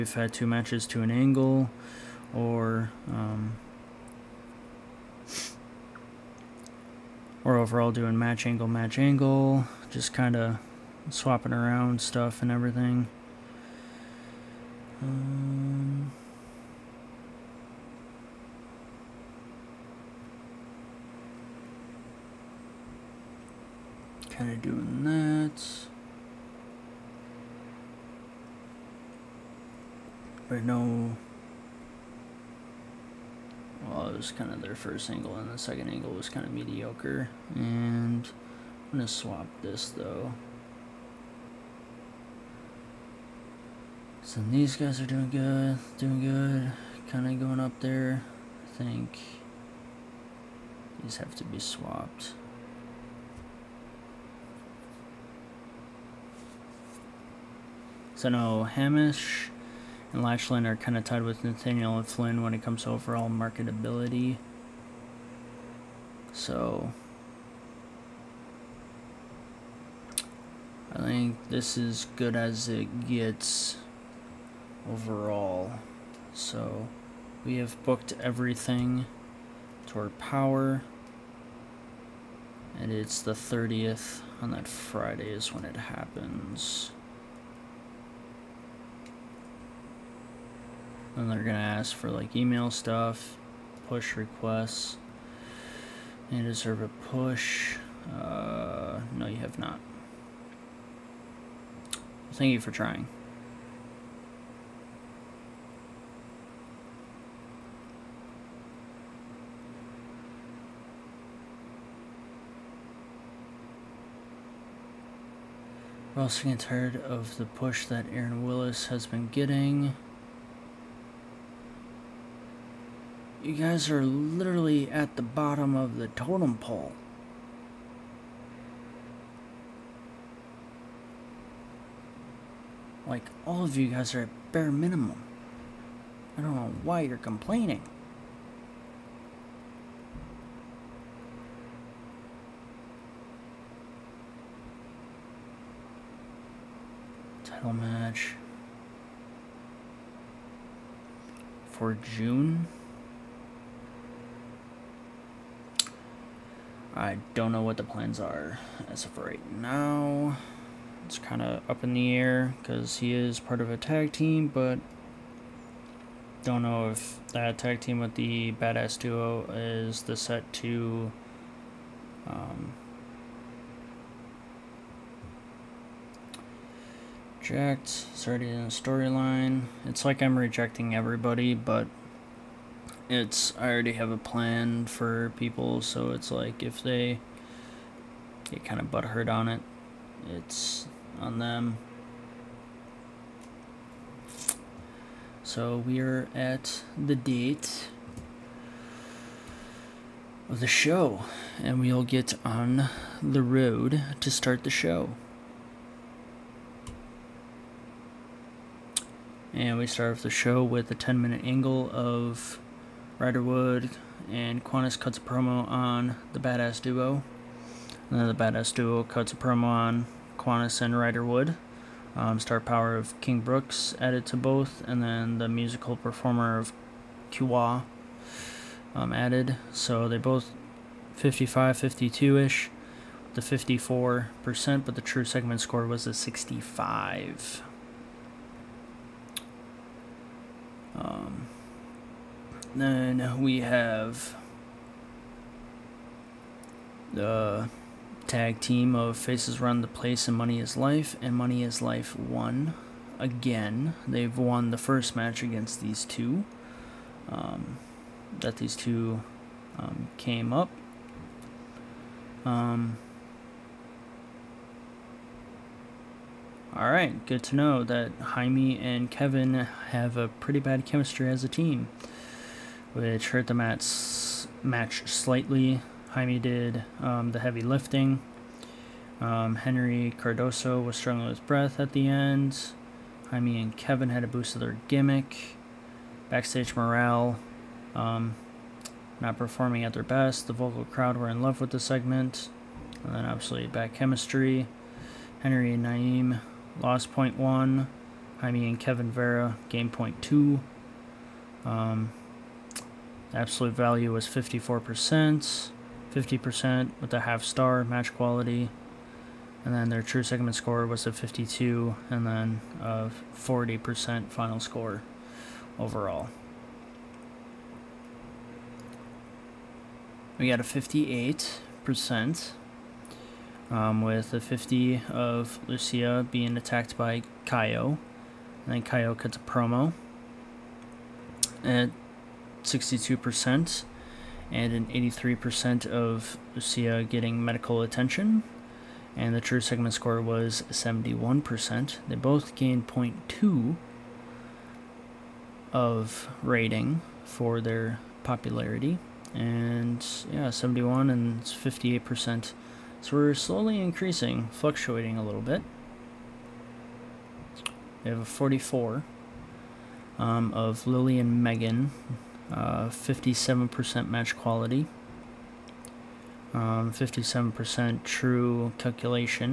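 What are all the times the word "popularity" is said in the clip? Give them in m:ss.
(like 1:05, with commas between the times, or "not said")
5:48.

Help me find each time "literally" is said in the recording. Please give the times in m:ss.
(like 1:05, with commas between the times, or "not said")
2:04.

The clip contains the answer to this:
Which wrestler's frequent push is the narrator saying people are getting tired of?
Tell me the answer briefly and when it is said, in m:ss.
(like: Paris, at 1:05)
Aaron Willis, at 1:58.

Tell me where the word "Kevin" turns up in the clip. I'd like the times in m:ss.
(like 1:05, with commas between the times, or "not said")
4:29, 4:43, 4:58.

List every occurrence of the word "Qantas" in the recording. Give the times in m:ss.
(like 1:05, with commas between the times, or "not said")
3:34, 3:40.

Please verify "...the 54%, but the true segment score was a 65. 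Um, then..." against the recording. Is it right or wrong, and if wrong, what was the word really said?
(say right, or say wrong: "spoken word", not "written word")
right.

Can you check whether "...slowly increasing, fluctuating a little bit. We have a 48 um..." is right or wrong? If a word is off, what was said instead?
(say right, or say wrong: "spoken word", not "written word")
wrong: "44", not "48".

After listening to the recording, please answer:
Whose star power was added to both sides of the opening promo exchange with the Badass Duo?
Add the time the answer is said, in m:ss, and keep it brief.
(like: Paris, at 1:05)
King Brooks, at 3:43.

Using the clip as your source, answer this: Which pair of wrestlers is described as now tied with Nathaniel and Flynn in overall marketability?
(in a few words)
Hamish and Lachlan.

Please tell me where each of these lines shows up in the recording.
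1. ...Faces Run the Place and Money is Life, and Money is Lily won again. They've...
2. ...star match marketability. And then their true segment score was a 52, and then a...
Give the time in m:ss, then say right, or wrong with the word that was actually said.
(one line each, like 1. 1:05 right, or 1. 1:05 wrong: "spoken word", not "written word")
1. 4:09 wrong: "Life", not "Lily"
2. 5:07 wrong: "quality", not "marketability".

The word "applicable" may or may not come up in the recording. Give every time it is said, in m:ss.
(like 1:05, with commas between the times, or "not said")
not said.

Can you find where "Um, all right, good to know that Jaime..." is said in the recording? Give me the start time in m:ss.
4:22.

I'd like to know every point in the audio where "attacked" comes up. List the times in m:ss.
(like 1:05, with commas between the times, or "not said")
5:26.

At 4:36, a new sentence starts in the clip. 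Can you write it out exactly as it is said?
Jaime did um, the heavy lifting.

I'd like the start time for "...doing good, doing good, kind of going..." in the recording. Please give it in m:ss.
0:45.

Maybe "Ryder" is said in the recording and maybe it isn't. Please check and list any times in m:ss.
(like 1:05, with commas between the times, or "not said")
3:33, 3:40.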